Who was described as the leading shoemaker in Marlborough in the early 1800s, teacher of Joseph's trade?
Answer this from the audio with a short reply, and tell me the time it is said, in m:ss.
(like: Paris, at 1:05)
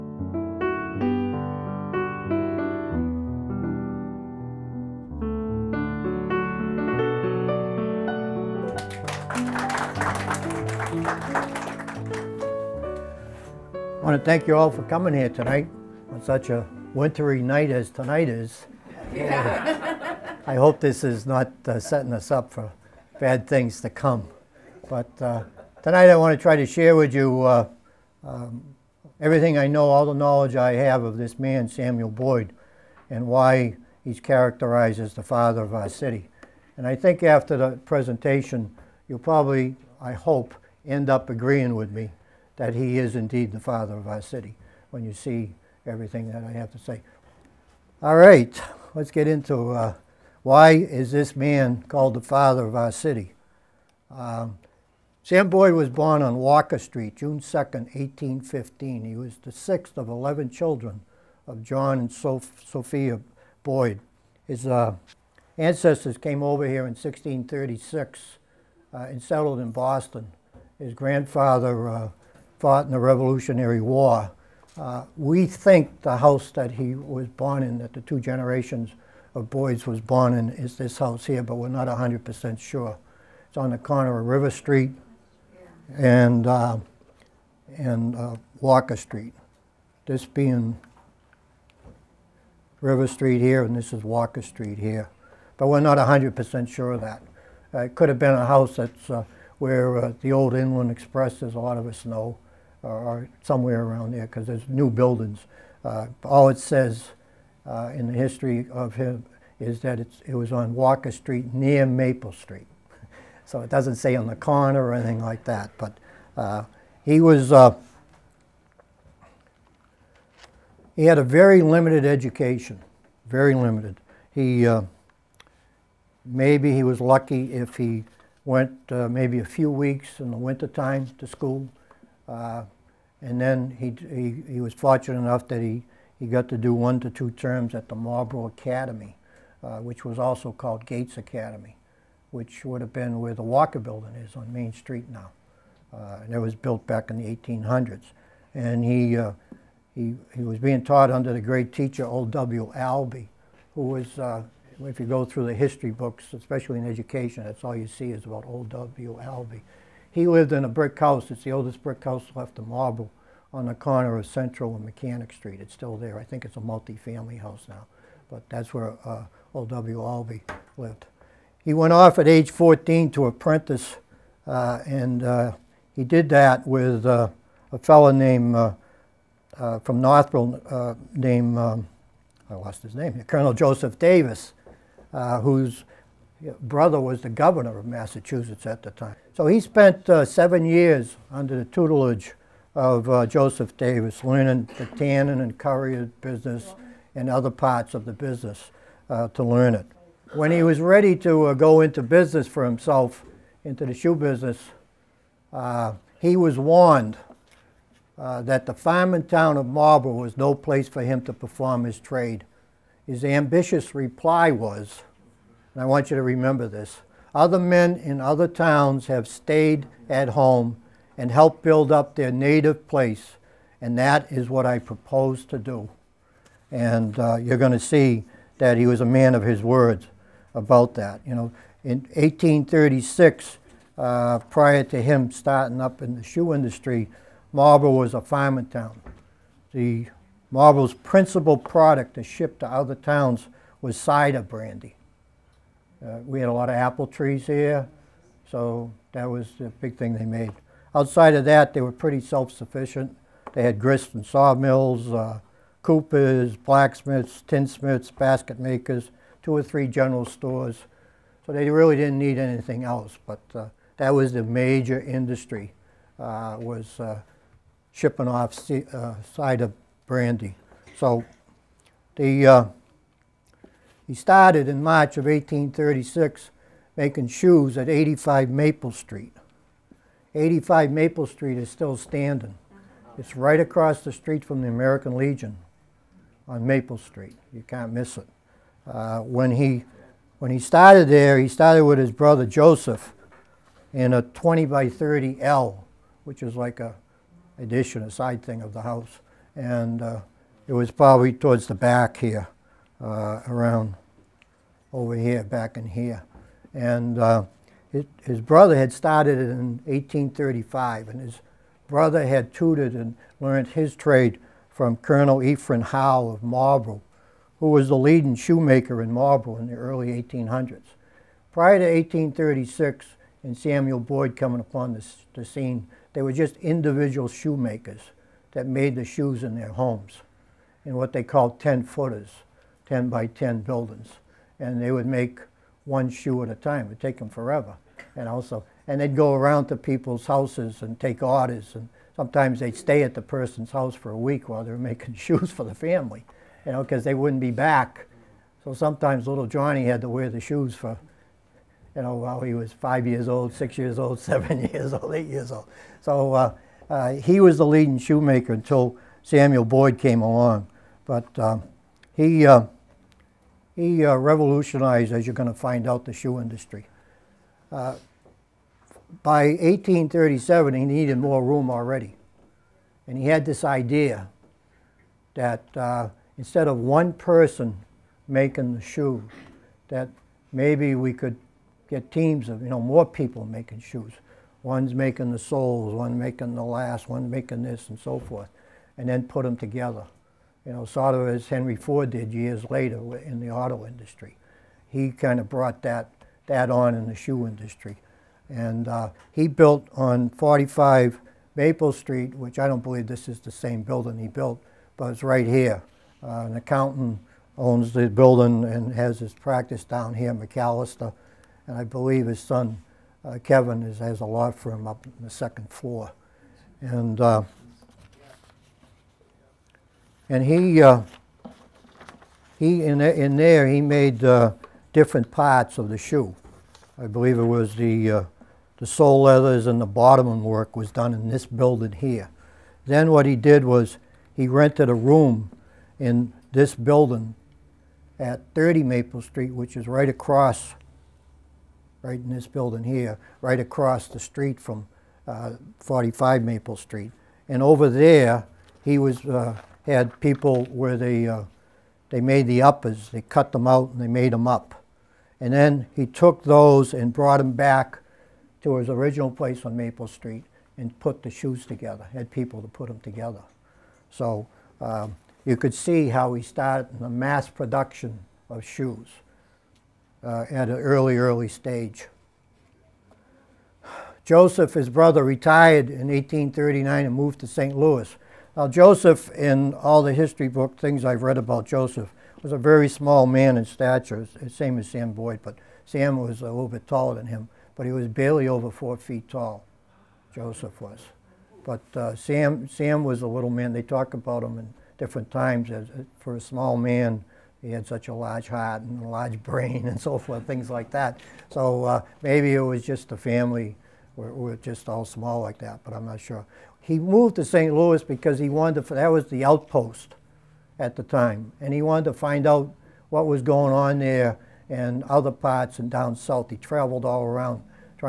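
Colonel Ephraim Howe, at 5:14.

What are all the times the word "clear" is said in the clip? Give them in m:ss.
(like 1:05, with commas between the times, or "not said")
not said.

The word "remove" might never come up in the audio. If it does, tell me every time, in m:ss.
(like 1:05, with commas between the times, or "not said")
not said.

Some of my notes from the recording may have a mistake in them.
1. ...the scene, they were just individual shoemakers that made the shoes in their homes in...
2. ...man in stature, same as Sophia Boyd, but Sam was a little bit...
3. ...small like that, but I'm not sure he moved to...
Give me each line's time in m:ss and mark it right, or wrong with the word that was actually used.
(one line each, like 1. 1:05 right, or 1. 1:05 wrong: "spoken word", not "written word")
1. 5:25 right
2. 8:03 wrong: "Sam", not "Sophia"
3. 8:25 right.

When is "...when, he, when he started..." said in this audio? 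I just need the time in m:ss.
4:49.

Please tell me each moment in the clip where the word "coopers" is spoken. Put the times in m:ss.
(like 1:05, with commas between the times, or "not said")
4:15.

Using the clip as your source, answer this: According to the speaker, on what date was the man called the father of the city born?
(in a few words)
June 2nd, 1815.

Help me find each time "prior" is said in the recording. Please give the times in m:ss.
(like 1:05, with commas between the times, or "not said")
3:54, 5:21.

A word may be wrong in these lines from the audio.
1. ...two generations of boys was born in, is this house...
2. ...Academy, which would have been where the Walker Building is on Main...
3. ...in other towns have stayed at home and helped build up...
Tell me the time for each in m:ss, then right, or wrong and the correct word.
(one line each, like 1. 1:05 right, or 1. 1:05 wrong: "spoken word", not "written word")
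1. 1:18 right
2. 2:21 right
3. 3:37 right.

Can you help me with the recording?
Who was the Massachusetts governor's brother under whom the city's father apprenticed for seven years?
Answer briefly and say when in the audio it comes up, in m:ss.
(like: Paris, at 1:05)
Colonel Joseph Davis, at 3:03.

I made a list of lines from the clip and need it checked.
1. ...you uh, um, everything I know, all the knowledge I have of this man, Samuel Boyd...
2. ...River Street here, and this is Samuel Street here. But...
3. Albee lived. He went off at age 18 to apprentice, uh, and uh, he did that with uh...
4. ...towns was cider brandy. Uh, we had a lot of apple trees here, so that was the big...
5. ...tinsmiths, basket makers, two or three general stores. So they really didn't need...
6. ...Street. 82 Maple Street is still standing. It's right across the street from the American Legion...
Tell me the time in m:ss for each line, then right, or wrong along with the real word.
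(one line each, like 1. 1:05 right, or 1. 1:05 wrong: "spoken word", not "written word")
1. 0:27 right
2. 1:32 wrong: "Walker", not "Samuel"
3. 2:50 wrong: "14", not "18"
4. 4:02 right
5. 4:17 right
6. 4:38 wrong: "85", not "82".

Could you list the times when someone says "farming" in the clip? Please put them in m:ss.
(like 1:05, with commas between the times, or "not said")
3:28, 3:58.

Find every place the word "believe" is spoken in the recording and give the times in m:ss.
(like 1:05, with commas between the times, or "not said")
6:42, 6:51, 7:07.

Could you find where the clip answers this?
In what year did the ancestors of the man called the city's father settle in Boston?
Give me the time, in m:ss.
1:06.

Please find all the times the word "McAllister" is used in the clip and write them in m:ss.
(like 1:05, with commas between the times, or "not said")
6:50.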